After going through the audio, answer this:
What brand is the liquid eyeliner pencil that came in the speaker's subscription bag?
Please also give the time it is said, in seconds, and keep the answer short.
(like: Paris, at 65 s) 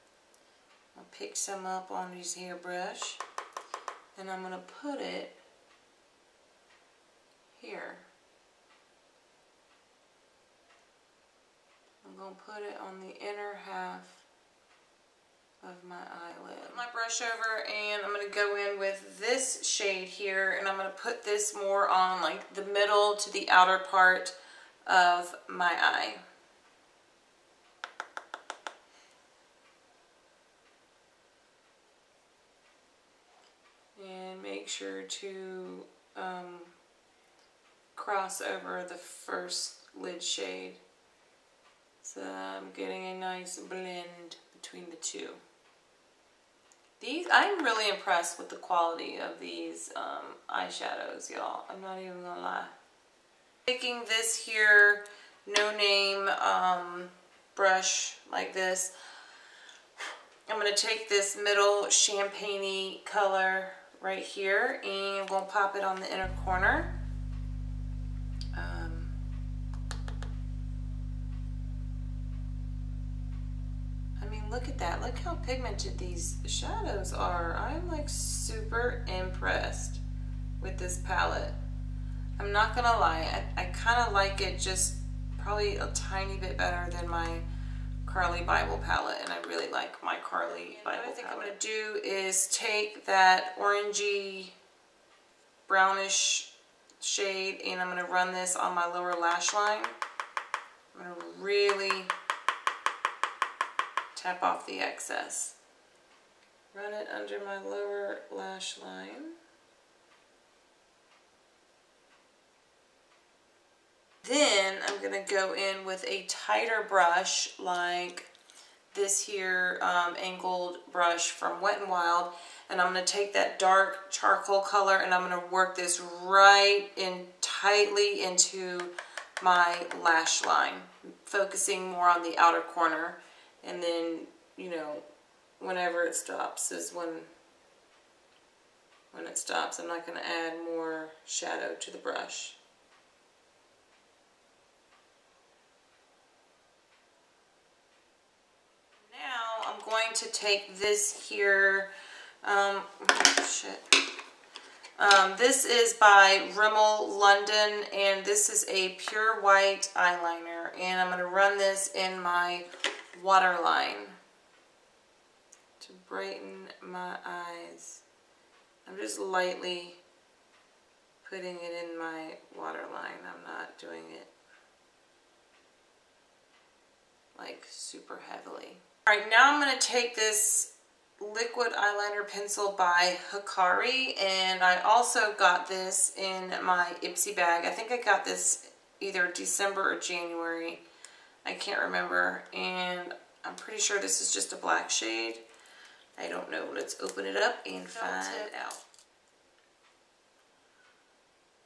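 Hikari, at 183 s.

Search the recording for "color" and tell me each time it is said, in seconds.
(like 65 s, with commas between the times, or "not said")
63 s, 124 s.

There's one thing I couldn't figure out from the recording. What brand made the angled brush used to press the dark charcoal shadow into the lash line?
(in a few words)
Wet n Wild.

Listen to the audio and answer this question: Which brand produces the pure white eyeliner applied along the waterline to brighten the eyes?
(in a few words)
Rimmel London.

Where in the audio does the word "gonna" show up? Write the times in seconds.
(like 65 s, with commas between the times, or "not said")
52 s, 60 s, 65 s, 179 s.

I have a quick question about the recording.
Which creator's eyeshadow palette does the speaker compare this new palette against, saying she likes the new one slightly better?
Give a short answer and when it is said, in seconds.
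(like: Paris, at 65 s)
Carli Bybel, at 88 s.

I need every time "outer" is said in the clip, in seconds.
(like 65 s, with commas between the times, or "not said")
23 s, 132 s.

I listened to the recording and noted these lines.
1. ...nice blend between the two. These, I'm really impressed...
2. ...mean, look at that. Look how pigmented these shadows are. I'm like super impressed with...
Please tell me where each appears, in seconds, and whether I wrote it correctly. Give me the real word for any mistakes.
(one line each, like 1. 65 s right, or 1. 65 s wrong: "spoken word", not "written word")
1. 43 s right
2. 74 s right.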